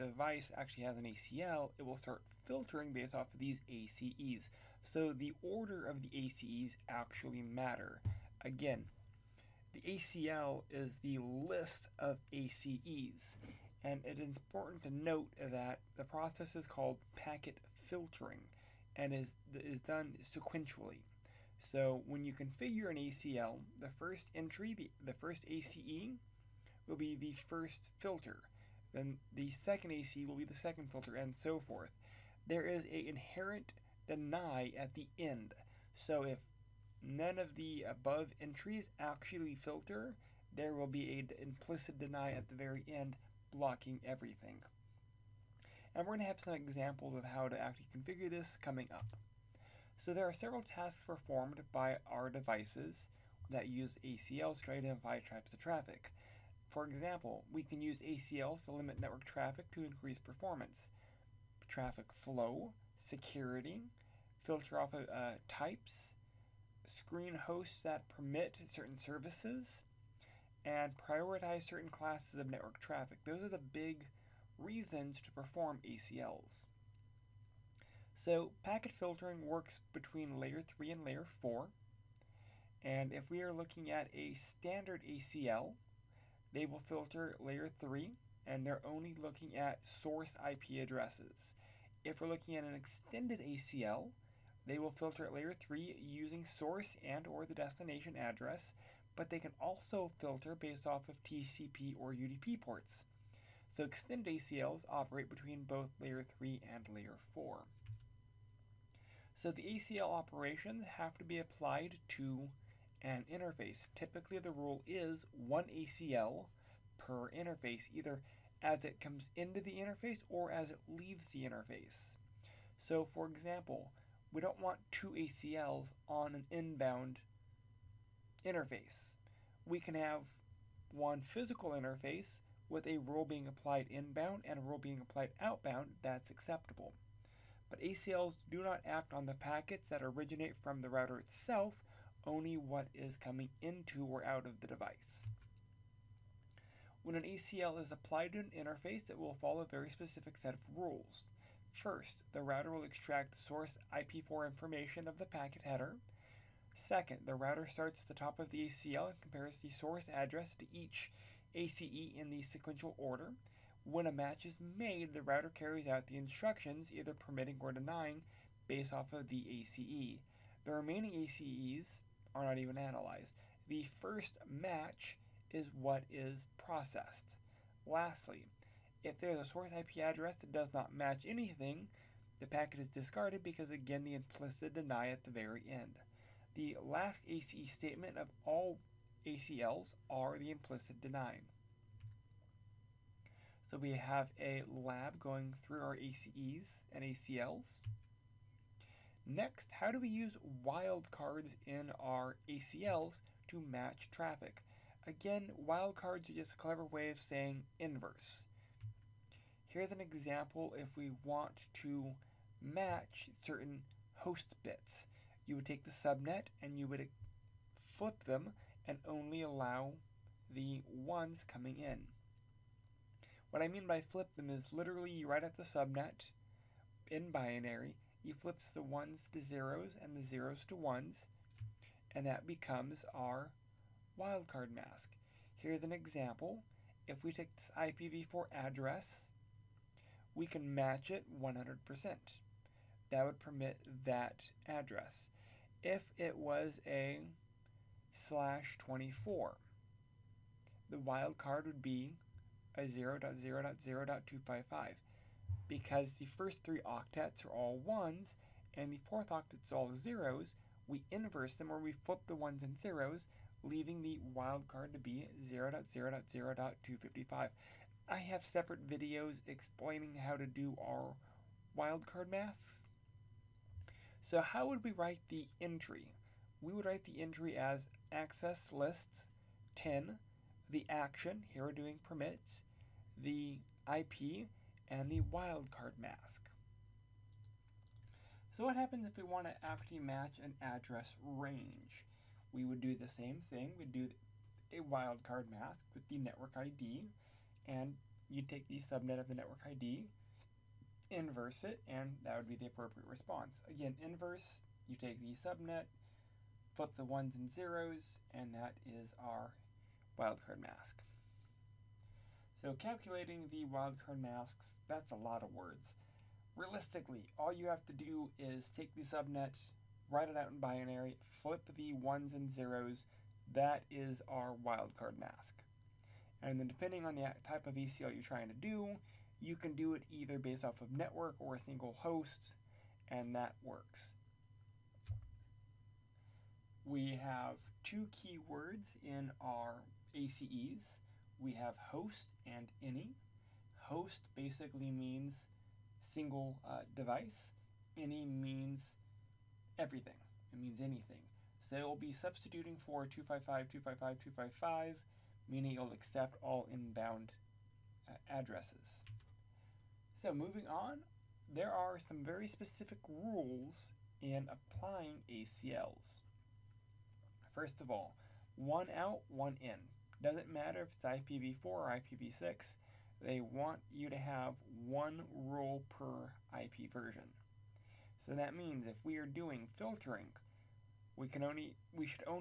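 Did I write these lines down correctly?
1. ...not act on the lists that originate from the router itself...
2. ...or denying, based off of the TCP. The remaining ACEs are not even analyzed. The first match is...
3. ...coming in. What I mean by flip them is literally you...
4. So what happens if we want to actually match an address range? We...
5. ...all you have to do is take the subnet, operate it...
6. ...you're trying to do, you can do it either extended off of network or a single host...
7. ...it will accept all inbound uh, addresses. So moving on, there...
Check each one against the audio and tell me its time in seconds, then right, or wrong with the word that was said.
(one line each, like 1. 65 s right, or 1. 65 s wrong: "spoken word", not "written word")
1. 138 s wrong: "packets", not "lists"
2. 167 s wrong: "ACE", not "TCP"
3. 221 s right
4. 288 s right
5. 317 s wrong: "write", not "operate"
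6. 328 s wrong: "based", not "extended"
7. 355 s right.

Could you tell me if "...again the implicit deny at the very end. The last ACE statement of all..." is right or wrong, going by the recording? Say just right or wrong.
right.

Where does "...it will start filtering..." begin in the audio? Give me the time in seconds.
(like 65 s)
1 s.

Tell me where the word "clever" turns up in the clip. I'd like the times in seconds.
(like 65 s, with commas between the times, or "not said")
206 s.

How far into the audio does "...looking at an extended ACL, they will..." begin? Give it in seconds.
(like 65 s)
92 s.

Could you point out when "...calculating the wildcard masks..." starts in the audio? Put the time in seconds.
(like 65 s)
312 s.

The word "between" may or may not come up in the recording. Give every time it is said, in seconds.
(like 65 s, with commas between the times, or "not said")
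79 s, 105 s.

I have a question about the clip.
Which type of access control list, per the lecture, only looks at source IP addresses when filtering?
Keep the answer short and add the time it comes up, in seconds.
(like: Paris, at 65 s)
standard ACL, at 84 s.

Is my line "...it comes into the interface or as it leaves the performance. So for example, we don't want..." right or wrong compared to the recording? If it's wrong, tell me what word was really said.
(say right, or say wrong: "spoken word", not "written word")
wrong: "interface", not "performance".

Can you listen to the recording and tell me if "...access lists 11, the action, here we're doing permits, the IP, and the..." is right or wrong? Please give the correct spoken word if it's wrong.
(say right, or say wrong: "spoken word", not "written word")
wrong: "10", not "11".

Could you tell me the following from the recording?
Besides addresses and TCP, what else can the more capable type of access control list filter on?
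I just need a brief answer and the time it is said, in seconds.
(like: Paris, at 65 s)
UDP ports, at 102 s.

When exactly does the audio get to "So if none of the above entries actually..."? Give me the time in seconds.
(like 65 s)
35 s.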